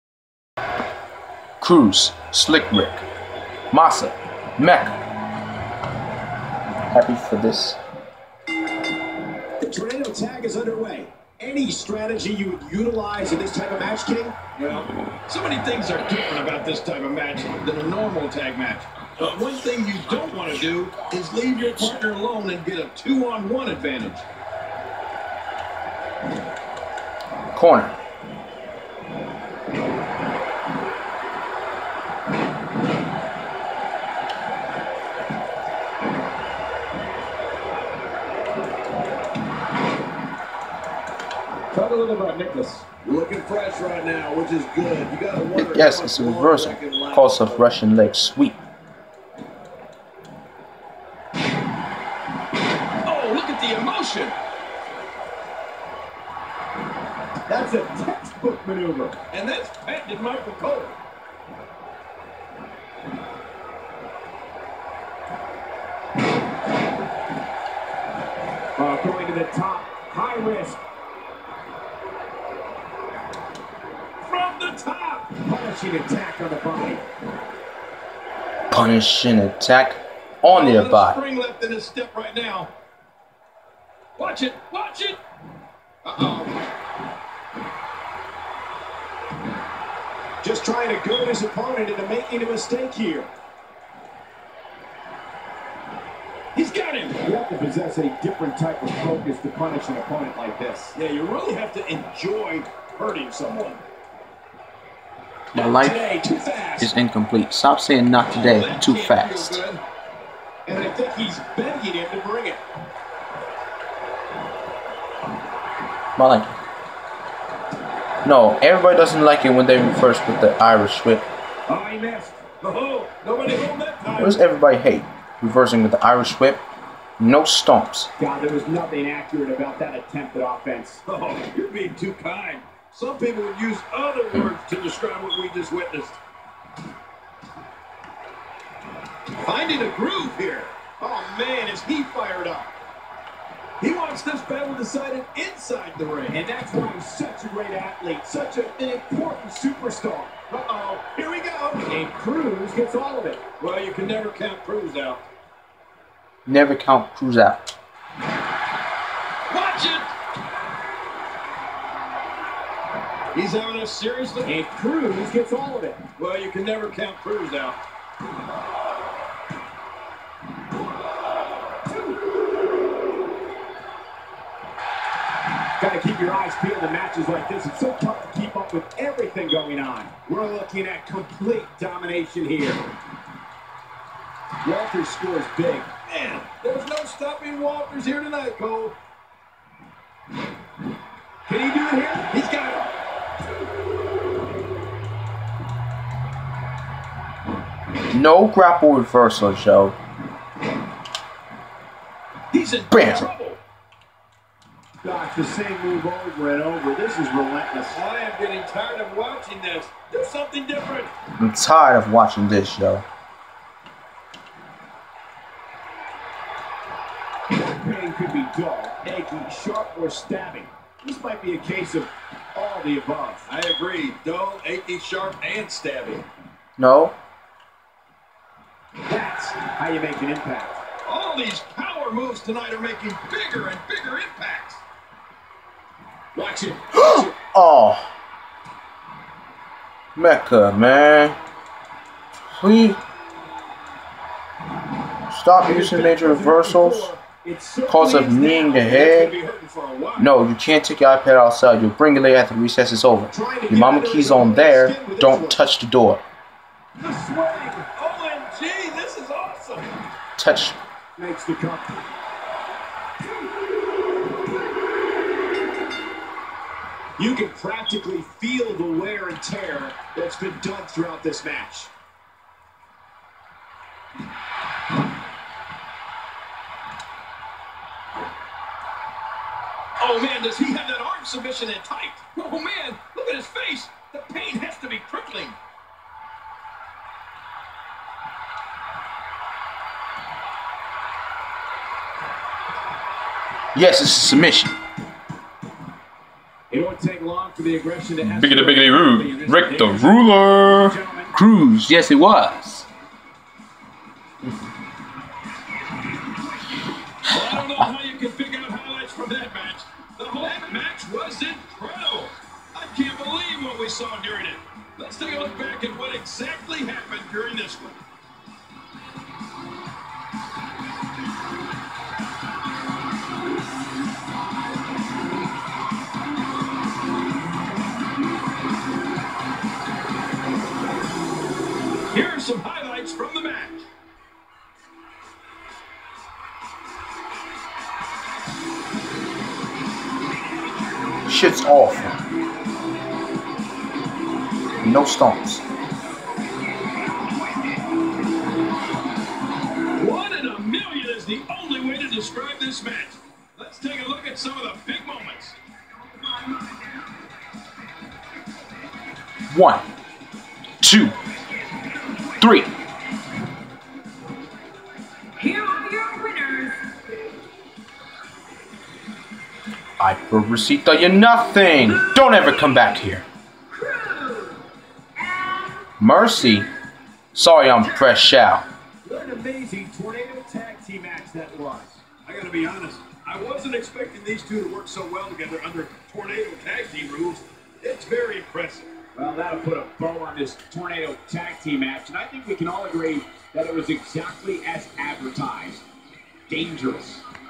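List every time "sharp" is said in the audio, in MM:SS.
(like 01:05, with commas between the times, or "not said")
03:39, 03:44.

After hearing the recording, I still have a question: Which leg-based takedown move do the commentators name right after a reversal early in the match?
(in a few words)
Russian leg sweep.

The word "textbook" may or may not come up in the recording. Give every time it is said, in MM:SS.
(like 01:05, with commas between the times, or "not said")
00:58.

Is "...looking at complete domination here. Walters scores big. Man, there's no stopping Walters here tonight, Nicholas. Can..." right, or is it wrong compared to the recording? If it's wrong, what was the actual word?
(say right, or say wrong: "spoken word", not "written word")
wrong: "Cole", not "Nicholas".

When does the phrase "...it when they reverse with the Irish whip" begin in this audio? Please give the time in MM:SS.
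01:59.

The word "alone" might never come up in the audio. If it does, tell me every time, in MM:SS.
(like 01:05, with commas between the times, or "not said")
00:22.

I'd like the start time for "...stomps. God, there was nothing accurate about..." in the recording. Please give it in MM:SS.
02:07.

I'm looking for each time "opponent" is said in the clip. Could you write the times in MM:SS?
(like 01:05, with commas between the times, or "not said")
01:31, 01:39.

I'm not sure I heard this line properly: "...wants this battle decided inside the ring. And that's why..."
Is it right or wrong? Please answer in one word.
right.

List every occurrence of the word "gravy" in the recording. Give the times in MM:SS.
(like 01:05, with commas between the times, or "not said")
not said.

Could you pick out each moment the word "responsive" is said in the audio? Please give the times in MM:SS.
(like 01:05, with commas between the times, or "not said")
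not said.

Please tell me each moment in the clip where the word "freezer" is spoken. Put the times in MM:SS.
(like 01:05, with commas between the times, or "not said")
not said.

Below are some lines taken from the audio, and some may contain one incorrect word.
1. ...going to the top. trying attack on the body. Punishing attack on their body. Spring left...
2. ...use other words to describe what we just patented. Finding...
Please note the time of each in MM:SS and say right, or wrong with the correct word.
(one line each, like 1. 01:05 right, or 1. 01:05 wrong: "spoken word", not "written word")
1. 01:09 wrong: "punishing", not "trying"
2. 02:13 wrong: "witnessed", not "patented".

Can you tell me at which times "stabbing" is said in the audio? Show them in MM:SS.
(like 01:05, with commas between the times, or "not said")
03:40, 03:45.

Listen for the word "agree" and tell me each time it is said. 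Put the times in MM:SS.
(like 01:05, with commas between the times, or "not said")
03:43, 06:32.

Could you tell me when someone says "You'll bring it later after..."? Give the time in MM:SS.
04:11.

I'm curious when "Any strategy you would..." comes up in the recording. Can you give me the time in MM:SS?
00:11.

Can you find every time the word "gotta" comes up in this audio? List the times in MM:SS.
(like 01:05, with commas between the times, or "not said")
00:45, 06:22.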